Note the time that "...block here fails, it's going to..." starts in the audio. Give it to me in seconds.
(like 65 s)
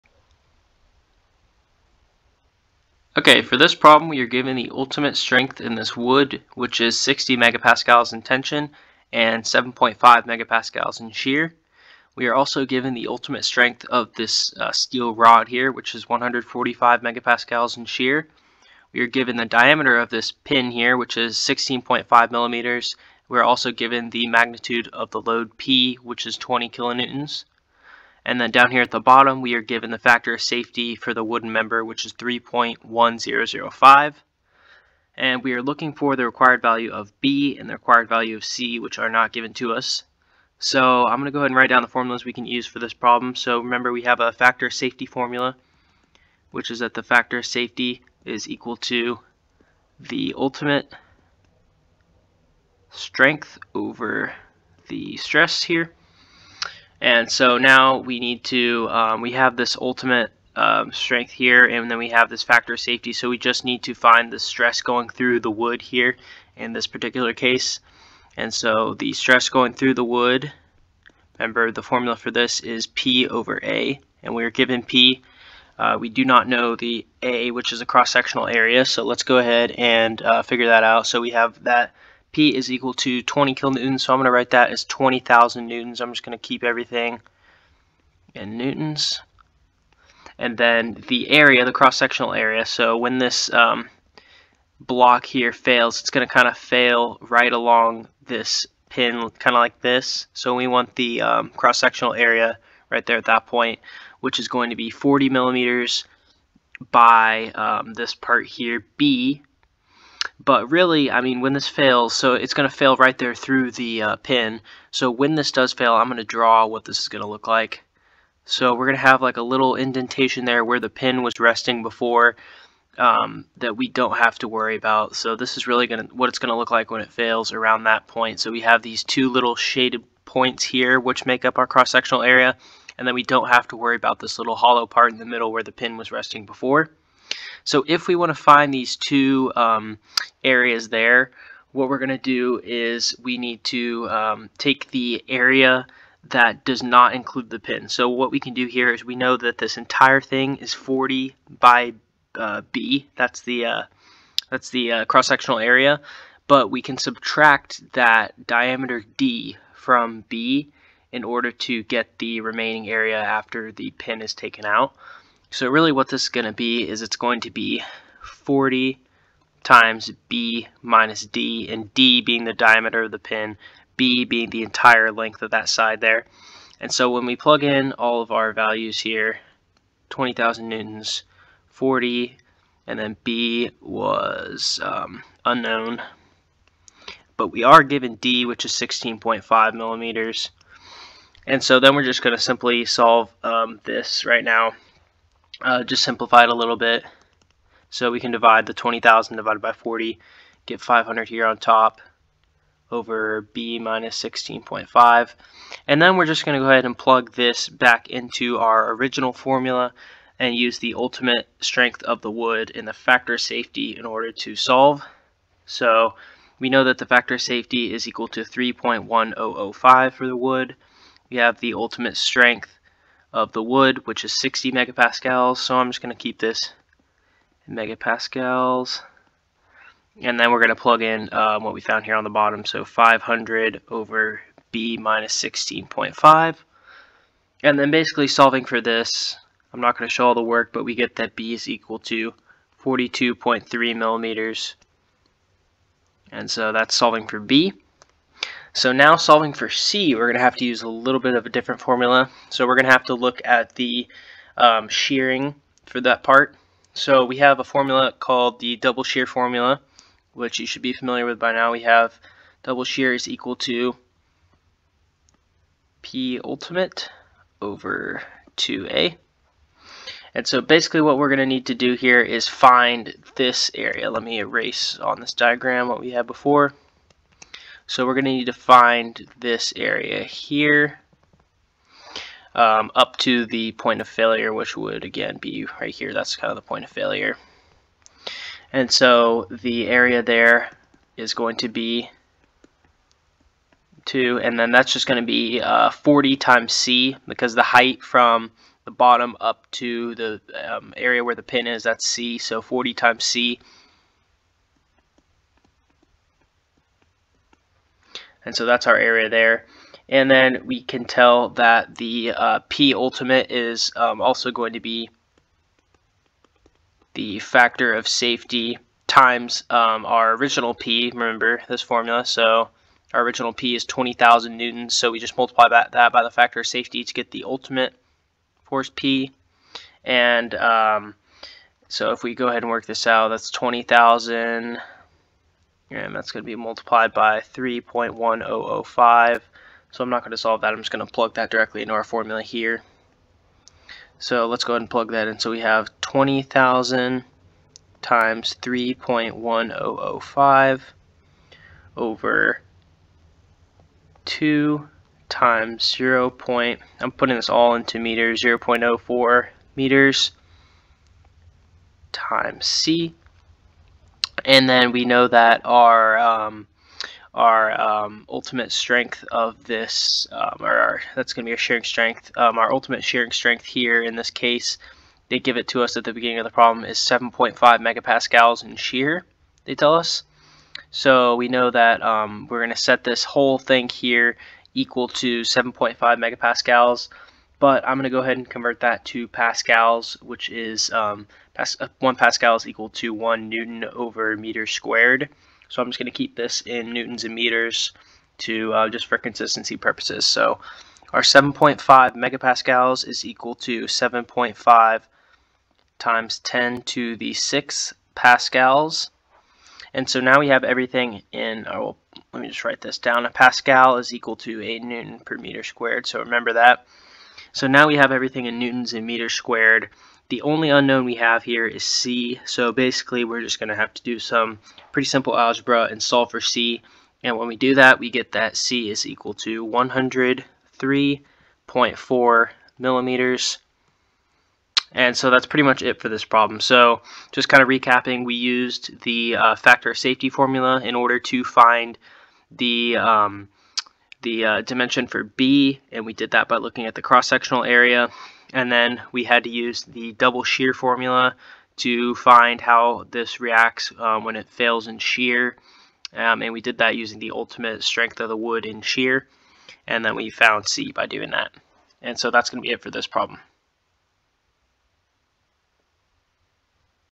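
94 s.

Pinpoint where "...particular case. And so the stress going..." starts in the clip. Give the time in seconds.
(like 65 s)
66 s.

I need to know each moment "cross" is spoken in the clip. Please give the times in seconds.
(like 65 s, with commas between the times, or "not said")
77 s, 91 s, 101 s, 131 s, 155 s, 447 s.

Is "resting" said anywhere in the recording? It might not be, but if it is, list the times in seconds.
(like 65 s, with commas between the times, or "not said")
121 s, 136 s.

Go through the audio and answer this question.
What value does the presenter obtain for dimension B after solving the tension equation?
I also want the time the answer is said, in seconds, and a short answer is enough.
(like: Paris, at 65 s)
42.3 millimeters, at 242 s.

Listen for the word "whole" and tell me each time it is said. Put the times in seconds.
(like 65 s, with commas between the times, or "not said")
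383 s.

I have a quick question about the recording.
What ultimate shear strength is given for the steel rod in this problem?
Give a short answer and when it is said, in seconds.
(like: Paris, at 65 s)
145 megapascals, at 16 s.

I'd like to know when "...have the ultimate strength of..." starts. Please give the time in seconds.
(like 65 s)
221 s.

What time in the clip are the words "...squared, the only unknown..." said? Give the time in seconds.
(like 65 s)
419 s.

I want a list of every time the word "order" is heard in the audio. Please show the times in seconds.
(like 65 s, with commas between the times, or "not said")
161 s, 214 s, 440 s.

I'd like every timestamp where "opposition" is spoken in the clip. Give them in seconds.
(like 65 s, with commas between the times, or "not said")
not said.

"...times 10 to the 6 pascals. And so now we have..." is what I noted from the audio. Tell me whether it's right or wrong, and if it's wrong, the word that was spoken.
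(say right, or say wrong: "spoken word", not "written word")
right.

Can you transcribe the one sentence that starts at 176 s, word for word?
And so when we plug in all of our values here, 20,000 newtons, 40, and then B was um, unknown.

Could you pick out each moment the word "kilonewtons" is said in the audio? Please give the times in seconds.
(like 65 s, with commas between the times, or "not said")
26 s, 83 s.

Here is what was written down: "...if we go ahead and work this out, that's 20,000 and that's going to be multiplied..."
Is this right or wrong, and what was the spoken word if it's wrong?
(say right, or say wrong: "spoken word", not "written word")
right.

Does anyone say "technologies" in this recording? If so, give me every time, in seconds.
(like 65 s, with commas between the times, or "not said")
not said.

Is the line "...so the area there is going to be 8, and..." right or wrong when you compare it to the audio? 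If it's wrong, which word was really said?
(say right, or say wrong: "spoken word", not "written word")
wrong: "2", not "8".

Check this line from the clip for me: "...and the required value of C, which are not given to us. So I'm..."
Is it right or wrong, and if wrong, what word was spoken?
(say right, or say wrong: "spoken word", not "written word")
right.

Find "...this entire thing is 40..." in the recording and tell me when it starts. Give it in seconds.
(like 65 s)
149 s.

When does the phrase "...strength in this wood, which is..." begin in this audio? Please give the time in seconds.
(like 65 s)
5 s.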